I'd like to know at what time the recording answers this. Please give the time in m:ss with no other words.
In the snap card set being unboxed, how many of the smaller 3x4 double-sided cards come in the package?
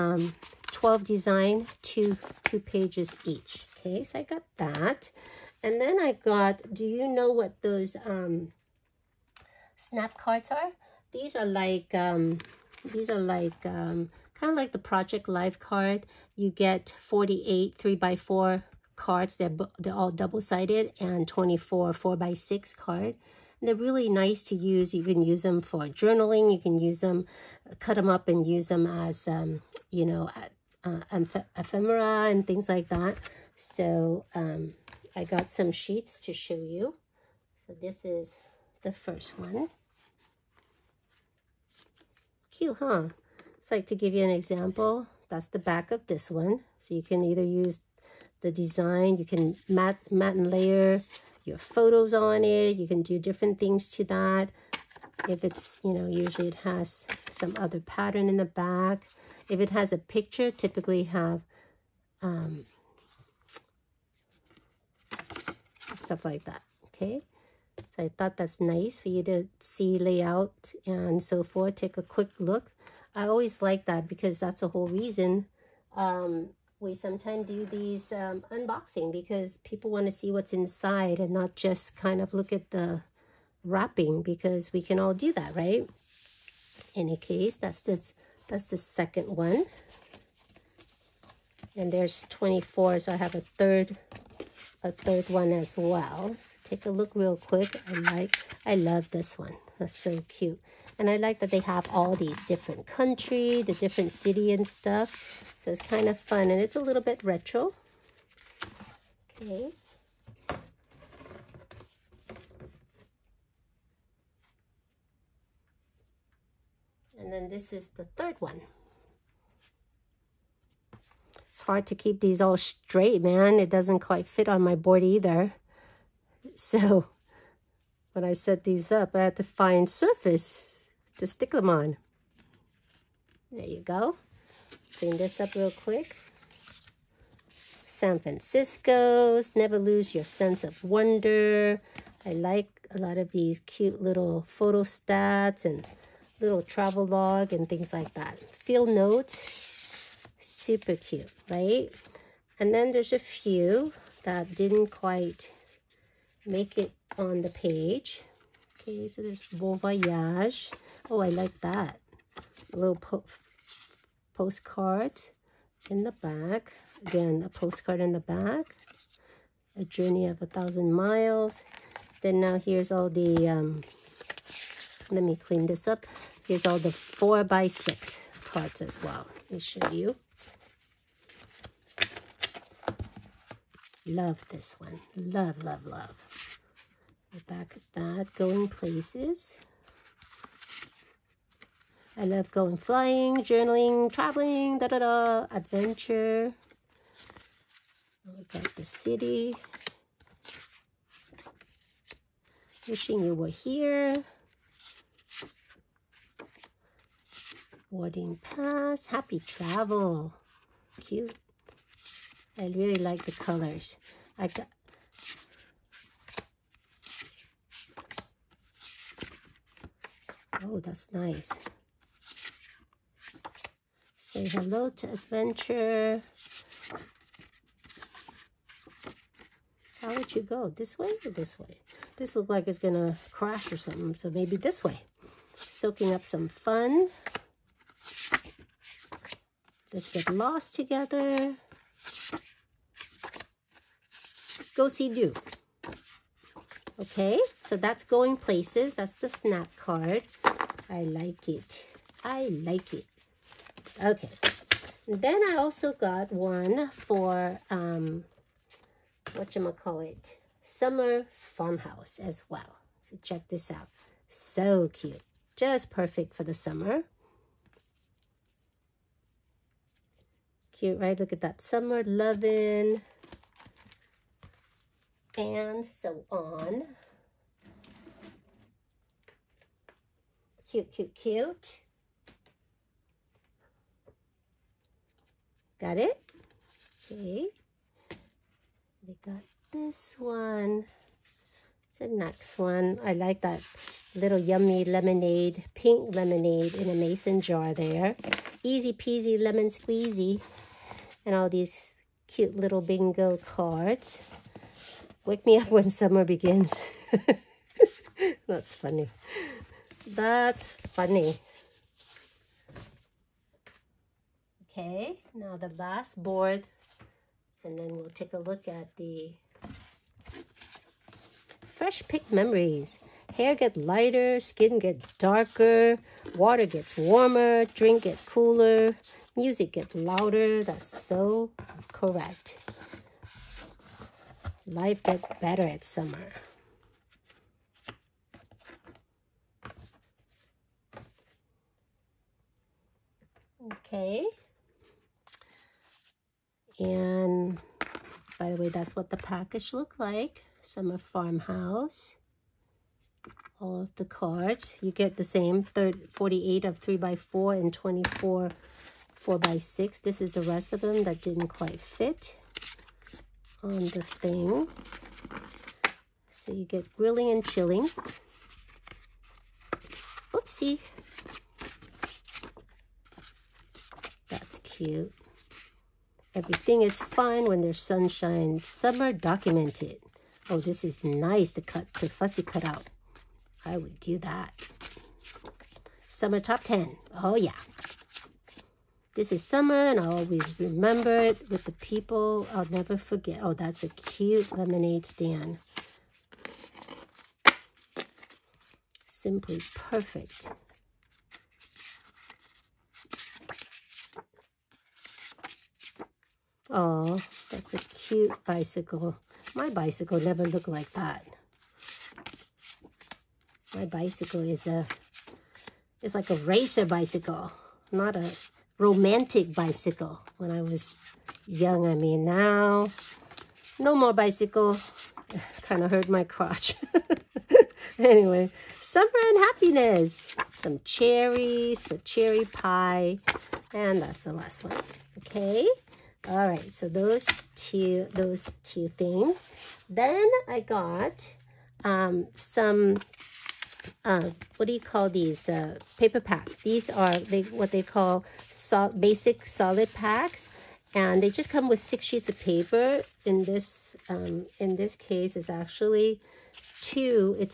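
0:16.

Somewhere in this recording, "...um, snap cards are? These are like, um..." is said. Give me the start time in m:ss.
0:08.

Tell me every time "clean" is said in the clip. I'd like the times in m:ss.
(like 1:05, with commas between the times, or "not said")
2:14, 2:55.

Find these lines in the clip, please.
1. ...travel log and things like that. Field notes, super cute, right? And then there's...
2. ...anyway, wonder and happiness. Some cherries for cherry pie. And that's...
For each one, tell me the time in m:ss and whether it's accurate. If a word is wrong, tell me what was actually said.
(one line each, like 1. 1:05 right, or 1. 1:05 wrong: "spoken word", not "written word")
1. 2:26 right
2. 7:07 wrong: "summer", not "wonder".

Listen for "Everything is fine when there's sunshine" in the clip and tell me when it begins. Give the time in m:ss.
6:16.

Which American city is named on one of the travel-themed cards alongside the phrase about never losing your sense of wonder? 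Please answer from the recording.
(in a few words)
San Francisco.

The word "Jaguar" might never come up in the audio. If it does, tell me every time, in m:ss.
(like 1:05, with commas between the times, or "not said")
not said.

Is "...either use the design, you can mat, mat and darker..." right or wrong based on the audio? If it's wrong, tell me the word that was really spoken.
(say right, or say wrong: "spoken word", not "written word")
wrong: "layer", not "darker".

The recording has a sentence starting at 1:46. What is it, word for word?
And it's a little bit retro.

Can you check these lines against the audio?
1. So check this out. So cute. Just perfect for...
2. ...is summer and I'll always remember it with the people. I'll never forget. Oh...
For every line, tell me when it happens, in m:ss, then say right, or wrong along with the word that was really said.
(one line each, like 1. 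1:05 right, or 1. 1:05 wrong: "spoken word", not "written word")
1. 4:23 right
2. 6:29 right.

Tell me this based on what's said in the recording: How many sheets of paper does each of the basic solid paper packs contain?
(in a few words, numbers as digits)
6.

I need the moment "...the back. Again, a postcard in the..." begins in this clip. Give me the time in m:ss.
2:46.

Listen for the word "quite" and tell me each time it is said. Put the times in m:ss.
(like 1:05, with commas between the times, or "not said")
2:03, 2:34, 6:01.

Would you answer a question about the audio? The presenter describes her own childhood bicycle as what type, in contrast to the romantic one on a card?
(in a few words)
racer bicycle.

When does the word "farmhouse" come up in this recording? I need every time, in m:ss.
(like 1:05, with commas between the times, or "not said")
4:21, 5:50.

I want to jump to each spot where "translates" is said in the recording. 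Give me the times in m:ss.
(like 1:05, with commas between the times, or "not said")
not said.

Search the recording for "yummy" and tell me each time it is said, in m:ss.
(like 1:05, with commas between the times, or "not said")
4:54.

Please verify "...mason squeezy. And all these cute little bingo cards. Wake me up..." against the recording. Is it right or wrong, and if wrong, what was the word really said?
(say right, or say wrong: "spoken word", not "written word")
wrong: "lemon", not "mason".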